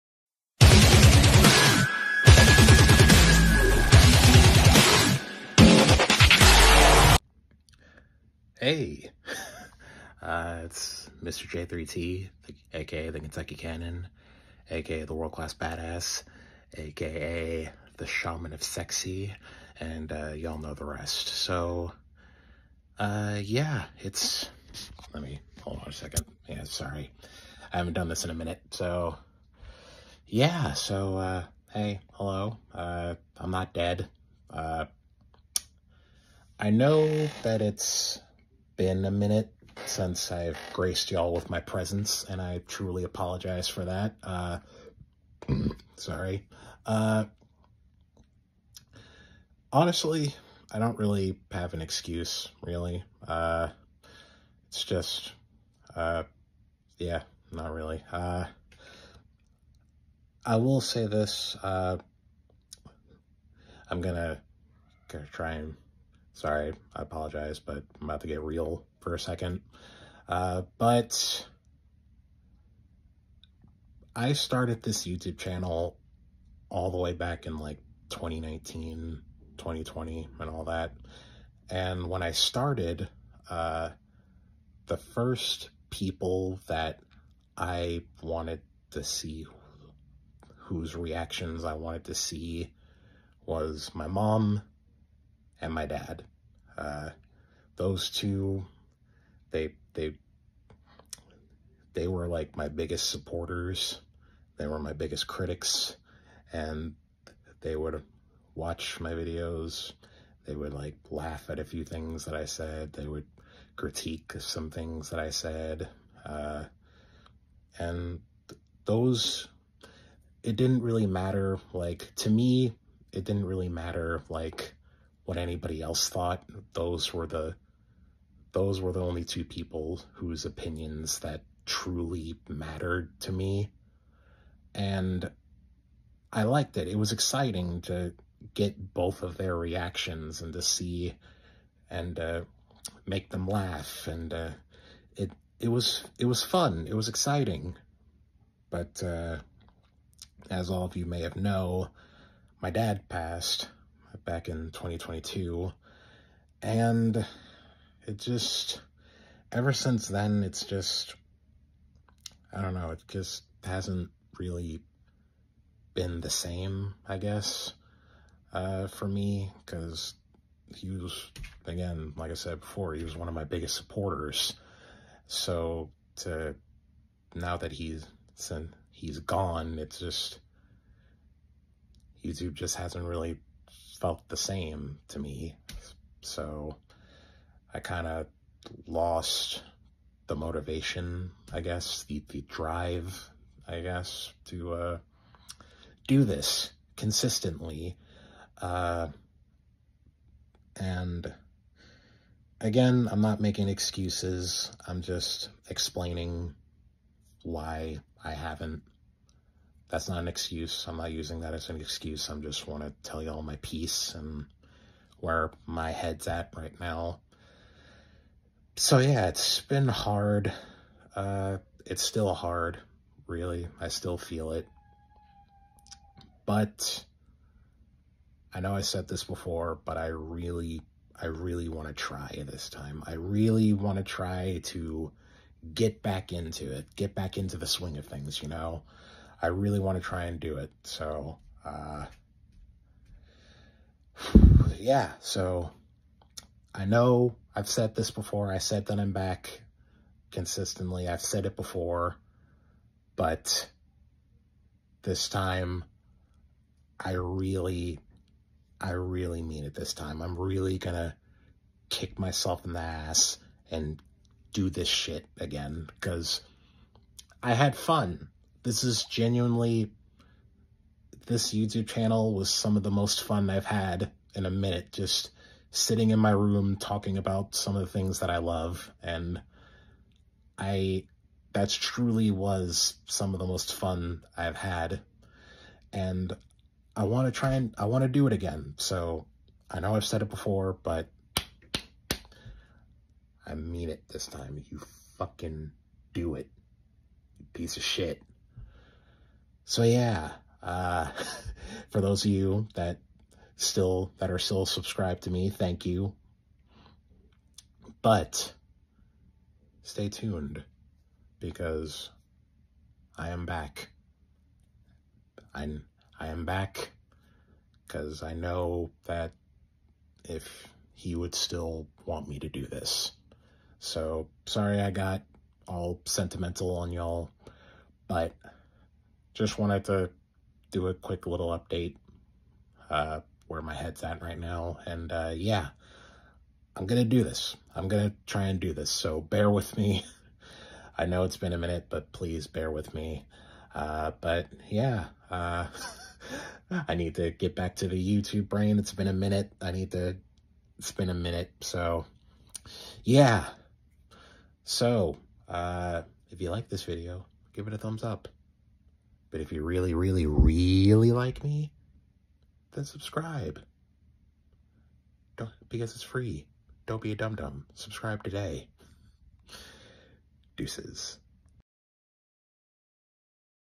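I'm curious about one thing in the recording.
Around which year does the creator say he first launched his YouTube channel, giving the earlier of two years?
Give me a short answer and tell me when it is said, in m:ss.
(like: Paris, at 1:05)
2019, at 1:18.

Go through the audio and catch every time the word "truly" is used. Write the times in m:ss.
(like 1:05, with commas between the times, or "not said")
0:42, 2:11, 4:41.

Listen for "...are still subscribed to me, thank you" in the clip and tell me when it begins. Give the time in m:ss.
5:04.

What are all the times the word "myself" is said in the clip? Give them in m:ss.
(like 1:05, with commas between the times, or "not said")
4:22.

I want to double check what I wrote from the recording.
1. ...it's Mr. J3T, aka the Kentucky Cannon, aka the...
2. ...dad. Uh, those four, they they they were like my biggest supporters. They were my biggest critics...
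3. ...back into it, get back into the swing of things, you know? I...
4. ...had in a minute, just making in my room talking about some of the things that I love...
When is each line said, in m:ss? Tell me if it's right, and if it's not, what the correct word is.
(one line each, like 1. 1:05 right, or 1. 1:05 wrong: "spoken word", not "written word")
1. 0:10 right
2. 1:35 wrong: "two", not "four"
3. 3:56 right
4. 4:33 wrong: "sitting", not "making".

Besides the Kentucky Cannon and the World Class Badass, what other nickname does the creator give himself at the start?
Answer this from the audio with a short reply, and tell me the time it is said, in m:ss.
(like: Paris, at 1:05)
Shaman of Sexy, at 0:18.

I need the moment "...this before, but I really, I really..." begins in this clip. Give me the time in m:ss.
3:49.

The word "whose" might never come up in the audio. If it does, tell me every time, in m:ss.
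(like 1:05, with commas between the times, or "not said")
1:30, 2:10.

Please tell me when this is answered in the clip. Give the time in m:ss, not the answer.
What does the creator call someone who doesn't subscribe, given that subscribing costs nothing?
6:07.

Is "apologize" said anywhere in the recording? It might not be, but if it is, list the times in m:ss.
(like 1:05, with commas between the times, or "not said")
0:43, 1:07.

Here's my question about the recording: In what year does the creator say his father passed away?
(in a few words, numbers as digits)
2022.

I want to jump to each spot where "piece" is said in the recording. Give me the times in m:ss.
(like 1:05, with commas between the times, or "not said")
3:33, 4:57.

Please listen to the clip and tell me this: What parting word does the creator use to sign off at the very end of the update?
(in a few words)
Deuces.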